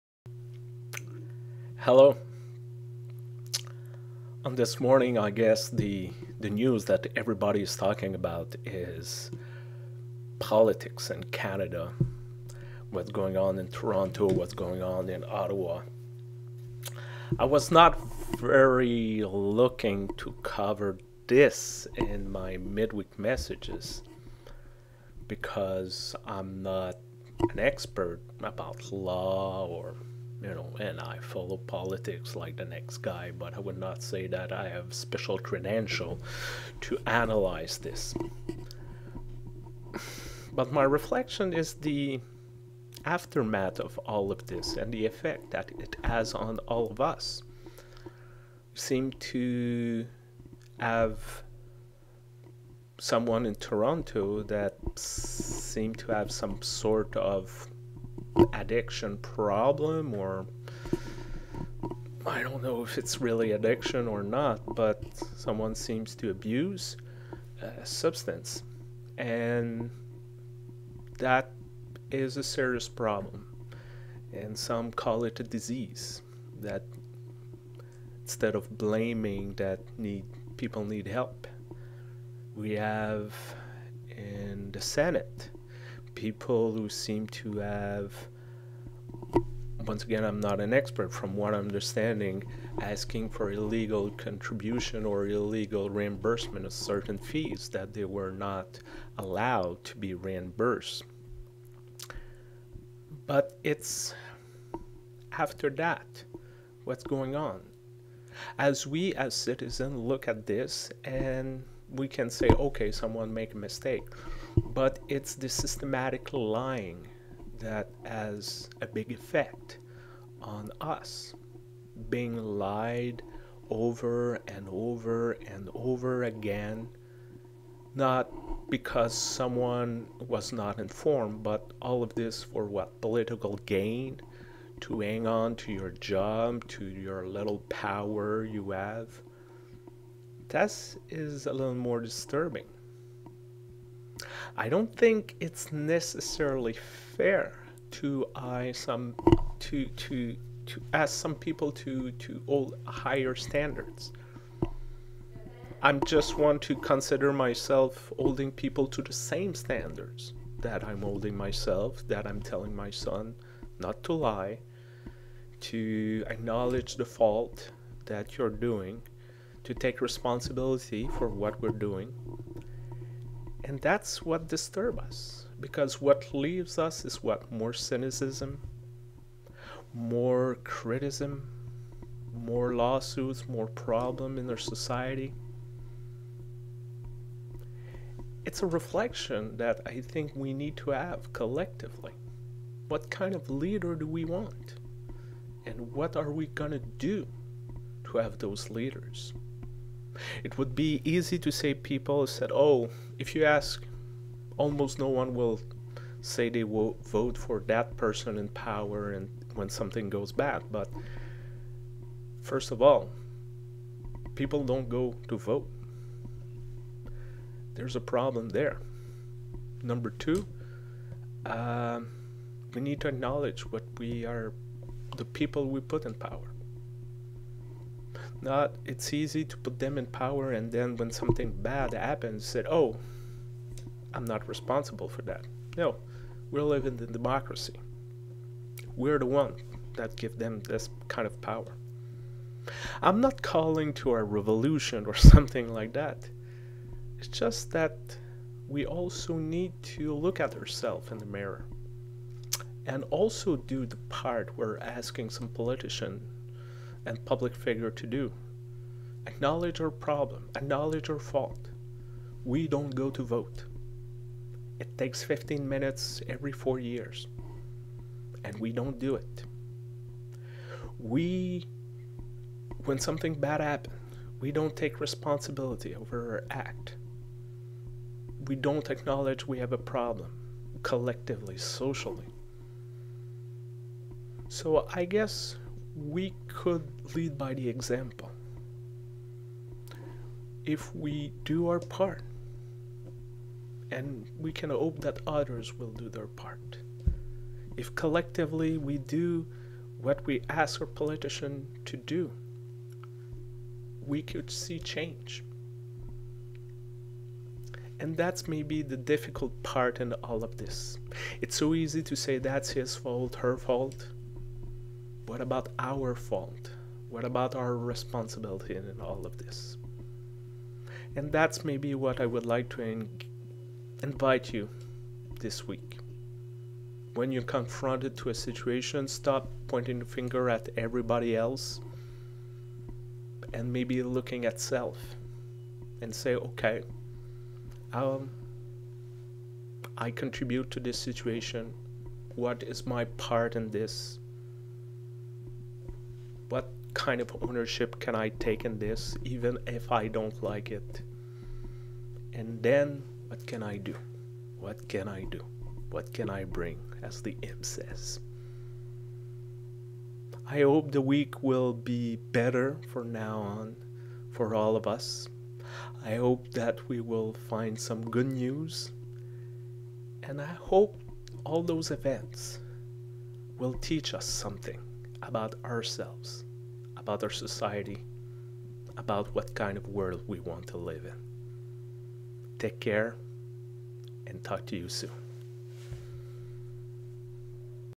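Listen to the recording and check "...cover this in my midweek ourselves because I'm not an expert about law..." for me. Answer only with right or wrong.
wrong.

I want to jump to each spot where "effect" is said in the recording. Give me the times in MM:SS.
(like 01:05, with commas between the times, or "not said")
00:45, 01:59.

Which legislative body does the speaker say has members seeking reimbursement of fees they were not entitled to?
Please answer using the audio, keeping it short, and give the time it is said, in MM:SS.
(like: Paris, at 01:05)
Senate, at 01:24.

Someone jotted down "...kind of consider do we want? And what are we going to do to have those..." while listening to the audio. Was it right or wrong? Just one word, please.
wrong.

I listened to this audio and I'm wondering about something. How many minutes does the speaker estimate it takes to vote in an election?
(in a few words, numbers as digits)
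15.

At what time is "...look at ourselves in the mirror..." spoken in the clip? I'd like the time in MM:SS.
04:10.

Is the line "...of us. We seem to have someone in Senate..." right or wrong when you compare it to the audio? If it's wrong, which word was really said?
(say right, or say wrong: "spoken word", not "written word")
wrong: "Toronto", not "Senate".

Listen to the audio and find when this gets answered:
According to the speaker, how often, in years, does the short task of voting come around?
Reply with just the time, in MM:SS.
04:26.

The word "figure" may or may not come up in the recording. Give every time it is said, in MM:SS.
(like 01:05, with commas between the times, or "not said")
04:17.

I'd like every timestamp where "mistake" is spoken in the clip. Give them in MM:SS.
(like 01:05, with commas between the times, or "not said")
01:53.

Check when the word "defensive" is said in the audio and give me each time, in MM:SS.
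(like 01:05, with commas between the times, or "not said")
not said.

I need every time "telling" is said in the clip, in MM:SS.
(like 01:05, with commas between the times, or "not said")
02:42.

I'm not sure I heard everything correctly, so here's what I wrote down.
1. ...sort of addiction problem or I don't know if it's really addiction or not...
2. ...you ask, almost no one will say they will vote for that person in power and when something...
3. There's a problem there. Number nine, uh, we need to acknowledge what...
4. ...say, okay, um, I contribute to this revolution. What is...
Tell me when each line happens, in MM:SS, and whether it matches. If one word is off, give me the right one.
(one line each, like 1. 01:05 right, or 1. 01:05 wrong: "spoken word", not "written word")
1. 00:56 right
2. 03:23 right
3. 03:37 wrong: "two", not "nine"
4. 05:36 wrong: "situation", not "revolution".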